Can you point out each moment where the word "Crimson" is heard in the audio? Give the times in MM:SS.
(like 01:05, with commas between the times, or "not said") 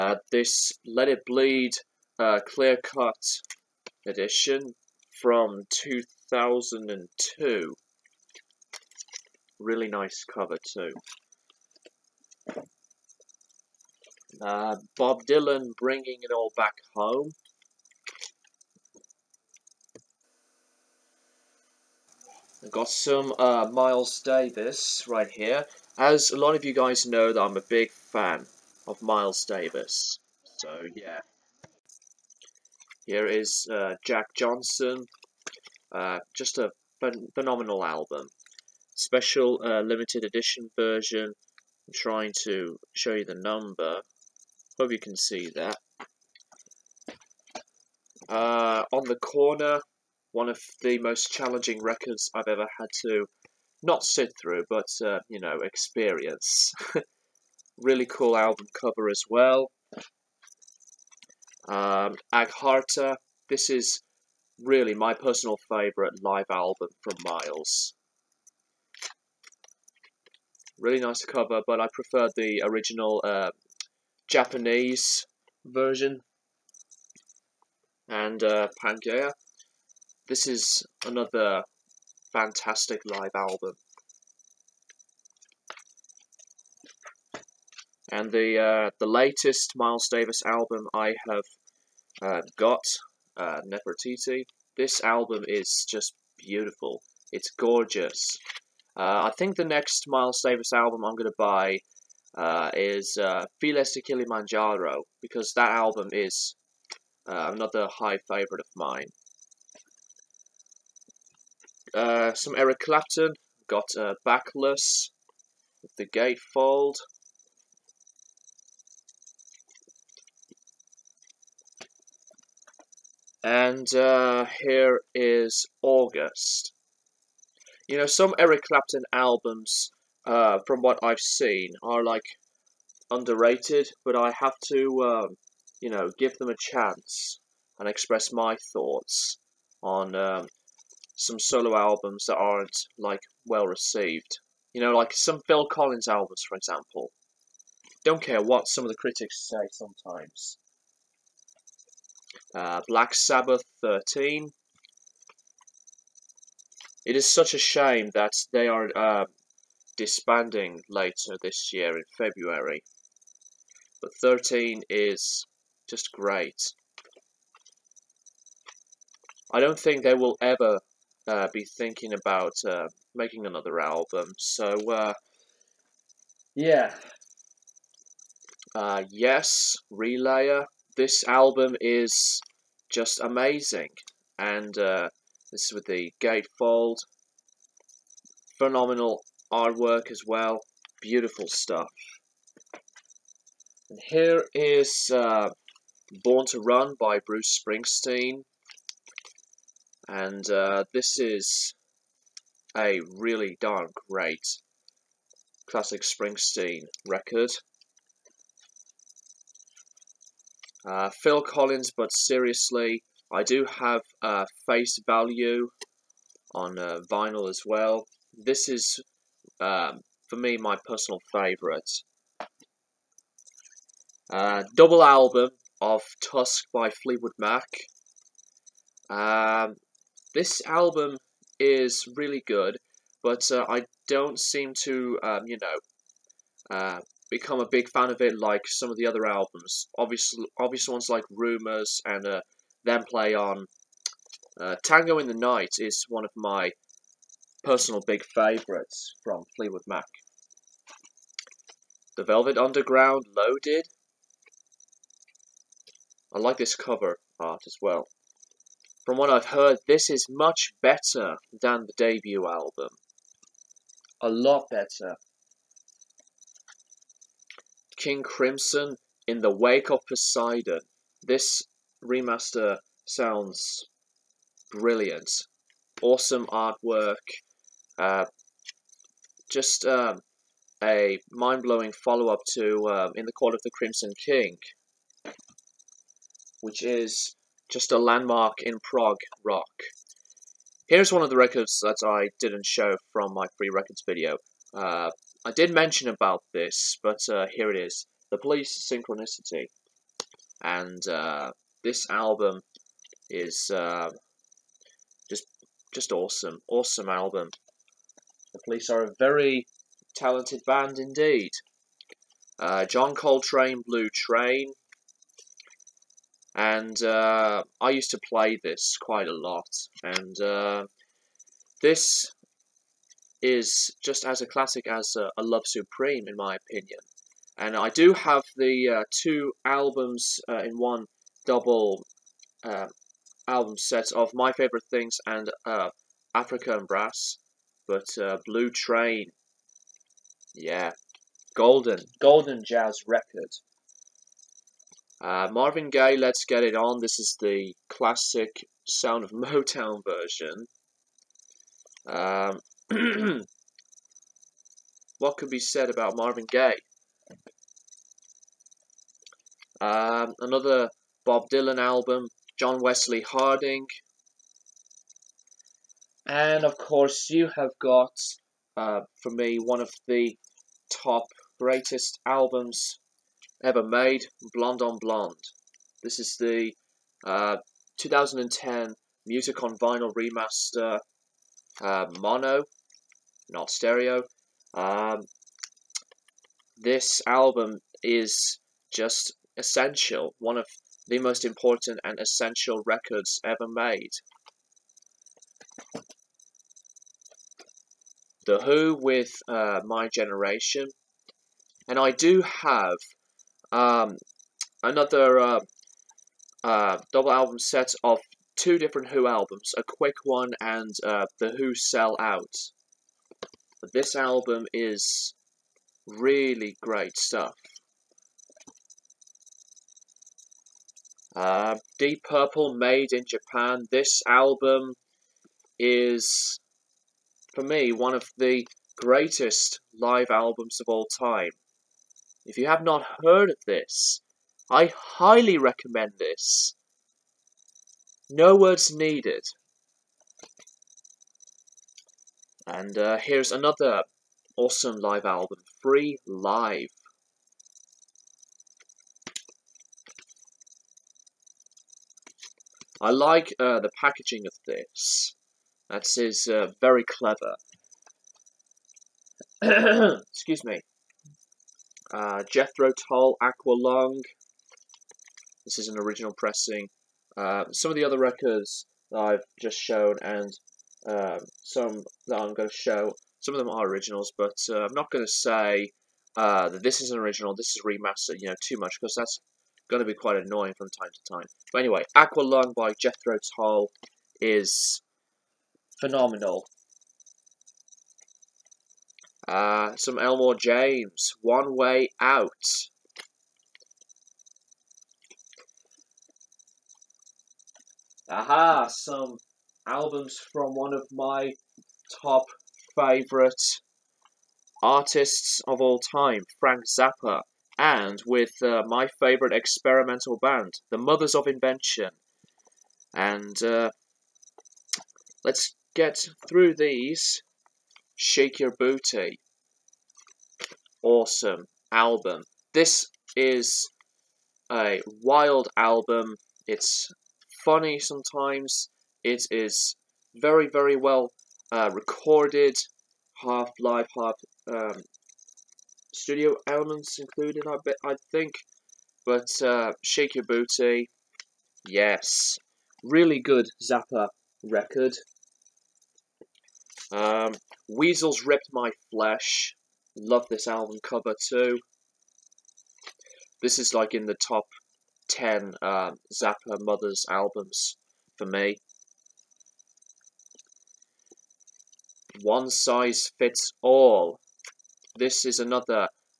04:28, 04:43.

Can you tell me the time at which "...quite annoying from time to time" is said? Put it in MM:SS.
08:00.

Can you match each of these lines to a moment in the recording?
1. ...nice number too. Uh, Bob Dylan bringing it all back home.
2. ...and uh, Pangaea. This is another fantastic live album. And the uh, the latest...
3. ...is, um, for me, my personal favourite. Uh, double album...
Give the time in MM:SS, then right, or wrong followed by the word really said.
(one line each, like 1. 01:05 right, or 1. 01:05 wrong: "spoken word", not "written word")
1. 00:09 wrong: "cover", not "number"
2. 01:18 right
3. 03:38 right.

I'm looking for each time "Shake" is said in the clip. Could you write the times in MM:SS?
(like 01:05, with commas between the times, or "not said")
08:38, 09:00.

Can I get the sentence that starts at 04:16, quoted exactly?
I like this cover art as well.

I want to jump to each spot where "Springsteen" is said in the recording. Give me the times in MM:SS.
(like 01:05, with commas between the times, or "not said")
03:17, 03:26.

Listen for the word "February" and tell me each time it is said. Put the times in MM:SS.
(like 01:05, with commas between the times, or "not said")
02:42.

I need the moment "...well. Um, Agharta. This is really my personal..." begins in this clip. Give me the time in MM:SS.
00:59.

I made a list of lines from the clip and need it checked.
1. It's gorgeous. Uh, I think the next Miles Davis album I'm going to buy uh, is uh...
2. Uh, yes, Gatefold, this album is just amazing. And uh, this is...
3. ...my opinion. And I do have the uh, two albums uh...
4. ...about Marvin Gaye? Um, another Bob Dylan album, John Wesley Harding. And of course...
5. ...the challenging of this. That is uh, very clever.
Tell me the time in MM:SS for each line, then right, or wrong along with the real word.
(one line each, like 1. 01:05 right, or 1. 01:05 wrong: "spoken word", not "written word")
1. 01:37 right
2. 02:58 wrong: "Relayer", not "Gatefold"
3. 05:26 right
4. 05:55 right
5. 07:33 wrong: "packaging", not "challenging".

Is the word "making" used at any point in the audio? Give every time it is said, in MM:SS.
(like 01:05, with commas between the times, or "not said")
02:53.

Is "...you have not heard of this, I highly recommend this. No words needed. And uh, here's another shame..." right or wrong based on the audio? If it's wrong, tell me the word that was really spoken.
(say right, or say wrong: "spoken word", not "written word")
wrong: "awesome", not "shame".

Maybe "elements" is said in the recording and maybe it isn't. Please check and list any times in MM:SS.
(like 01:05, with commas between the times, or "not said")
08:56.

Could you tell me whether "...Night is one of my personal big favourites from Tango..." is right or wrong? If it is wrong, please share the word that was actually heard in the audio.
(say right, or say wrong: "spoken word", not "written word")
wrong: "Fleetwood", not "Tango".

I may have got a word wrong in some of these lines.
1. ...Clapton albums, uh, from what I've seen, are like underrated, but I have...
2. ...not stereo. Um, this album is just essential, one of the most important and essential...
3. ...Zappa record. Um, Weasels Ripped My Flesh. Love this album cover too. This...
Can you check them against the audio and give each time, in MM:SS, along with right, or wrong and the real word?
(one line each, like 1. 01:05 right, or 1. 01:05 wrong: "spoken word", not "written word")
1. 02:08 right
2. 06:23 right
3. 09:03 right.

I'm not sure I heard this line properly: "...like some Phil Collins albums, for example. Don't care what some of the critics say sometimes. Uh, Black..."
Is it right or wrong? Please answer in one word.
right.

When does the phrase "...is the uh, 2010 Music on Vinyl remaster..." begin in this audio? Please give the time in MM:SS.
06:16.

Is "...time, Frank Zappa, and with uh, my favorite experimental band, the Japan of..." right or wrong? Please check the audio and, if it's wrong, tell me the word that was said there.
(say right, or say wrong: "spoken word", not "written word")
wrong: "Mothers", not "Japan".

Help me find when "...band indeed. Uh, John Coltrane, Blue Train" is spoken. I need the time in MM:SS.
05:10.